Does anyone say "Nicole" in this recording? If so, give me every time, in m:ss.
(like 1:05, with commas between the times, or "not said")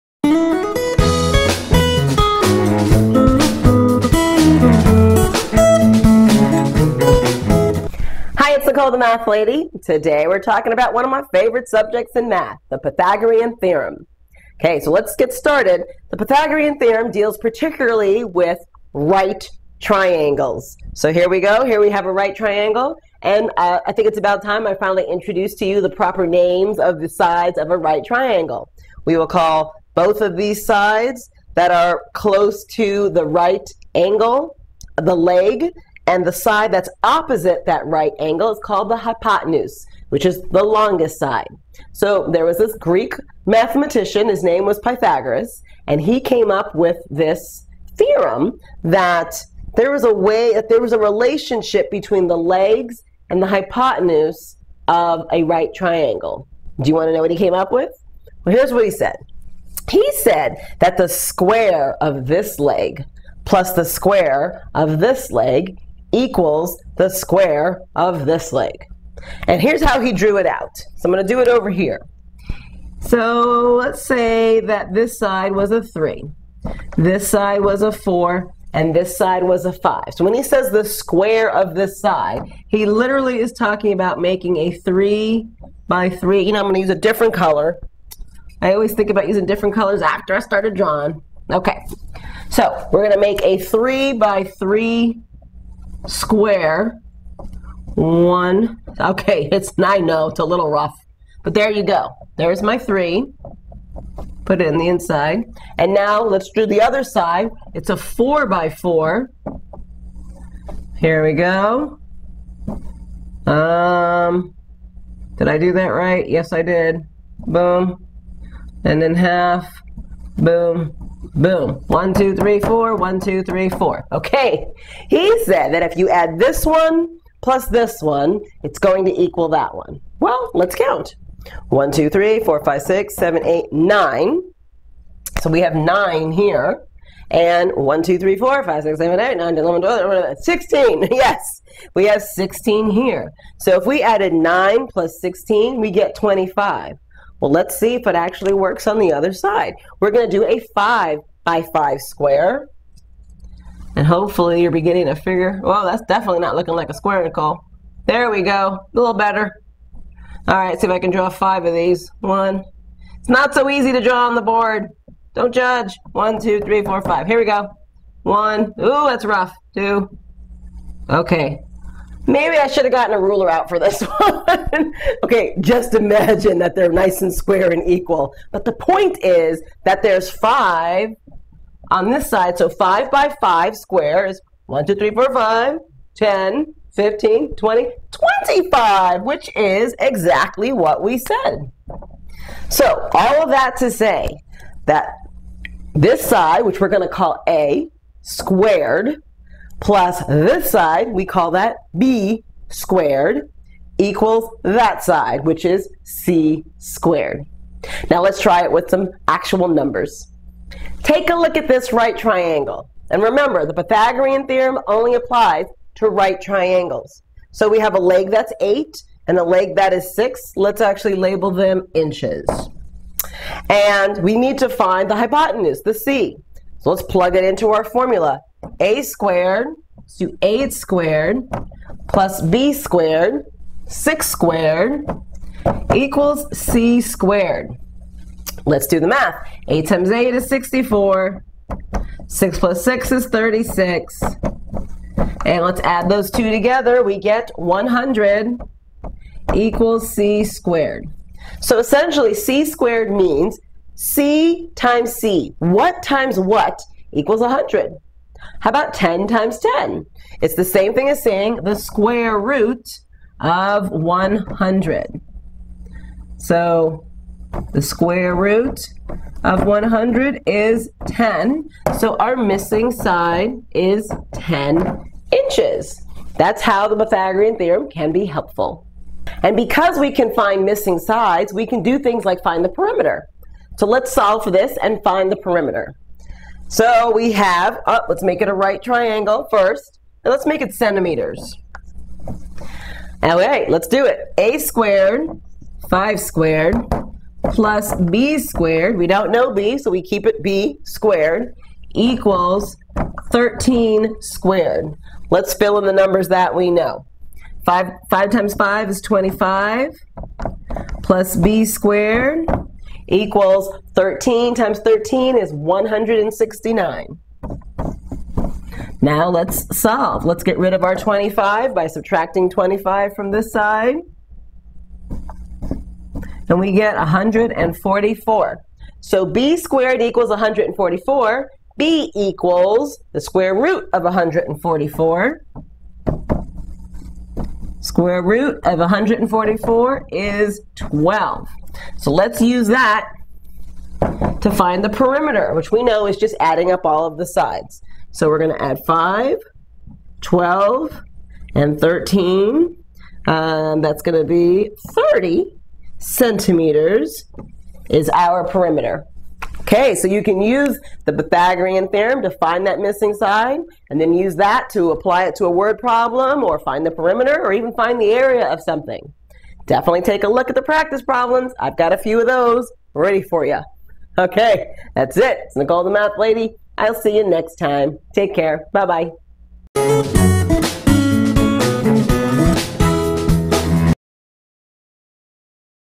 0:08, 2:37, 6:15.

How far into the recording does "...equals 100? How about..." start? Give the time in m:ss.
4:17.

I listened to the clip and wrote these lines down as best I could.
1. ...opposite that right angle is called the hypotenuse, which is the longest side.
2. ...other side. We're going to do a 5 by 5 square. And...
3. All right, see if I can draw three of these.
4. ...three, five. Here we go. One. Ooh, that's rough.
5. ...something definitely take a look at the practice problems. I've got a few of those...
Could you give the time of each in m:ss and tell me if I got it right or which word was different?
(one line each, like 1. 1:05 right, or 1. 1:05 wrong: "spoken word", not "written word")
1. 0:37 right
2. 2:29 right
3. 2:40 wrong: "five", not "three"
4. 2:46 wrong: "four", not "three"
5. 6:08 right.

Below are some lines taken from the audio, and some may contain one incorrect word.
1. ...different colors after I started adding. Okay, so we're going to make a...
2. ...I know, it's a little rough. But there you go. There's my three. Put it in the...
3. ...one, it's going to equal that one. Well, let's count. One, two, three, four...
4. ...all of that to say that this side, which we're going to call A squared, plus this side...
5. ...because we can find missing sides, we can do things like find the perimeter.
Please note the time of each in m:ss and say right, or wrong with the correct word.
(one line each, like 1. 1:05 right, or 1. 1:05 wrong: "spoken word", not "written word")
1. 1:29 wrong: "drawing", not "adding"
2. 1:39 right
3. 2:08 right
4. 3:13 right
5. 4:39 right.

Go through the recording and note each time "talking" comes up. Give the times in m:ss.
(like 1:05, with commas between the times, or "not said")
0:10, 1:23.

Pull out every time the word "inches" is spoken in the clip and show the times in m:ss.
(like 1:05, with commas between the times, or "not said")
3:41, 4:35.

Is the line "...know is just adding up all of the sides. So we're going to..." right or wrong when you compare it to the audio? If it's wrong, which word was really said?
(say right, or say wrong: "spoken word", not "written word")
right.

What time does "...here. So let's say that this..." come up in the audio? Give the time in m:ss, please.
1:11.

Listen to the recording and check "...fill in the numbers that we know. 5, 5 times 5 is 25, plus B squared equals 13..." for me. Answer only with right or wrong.
right.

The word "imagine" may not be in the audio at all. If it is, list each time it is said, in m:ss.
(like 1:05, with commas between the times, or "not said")
2:55.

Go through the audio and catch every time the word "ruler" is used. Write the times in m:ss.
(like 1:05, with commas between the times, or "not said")
2:53.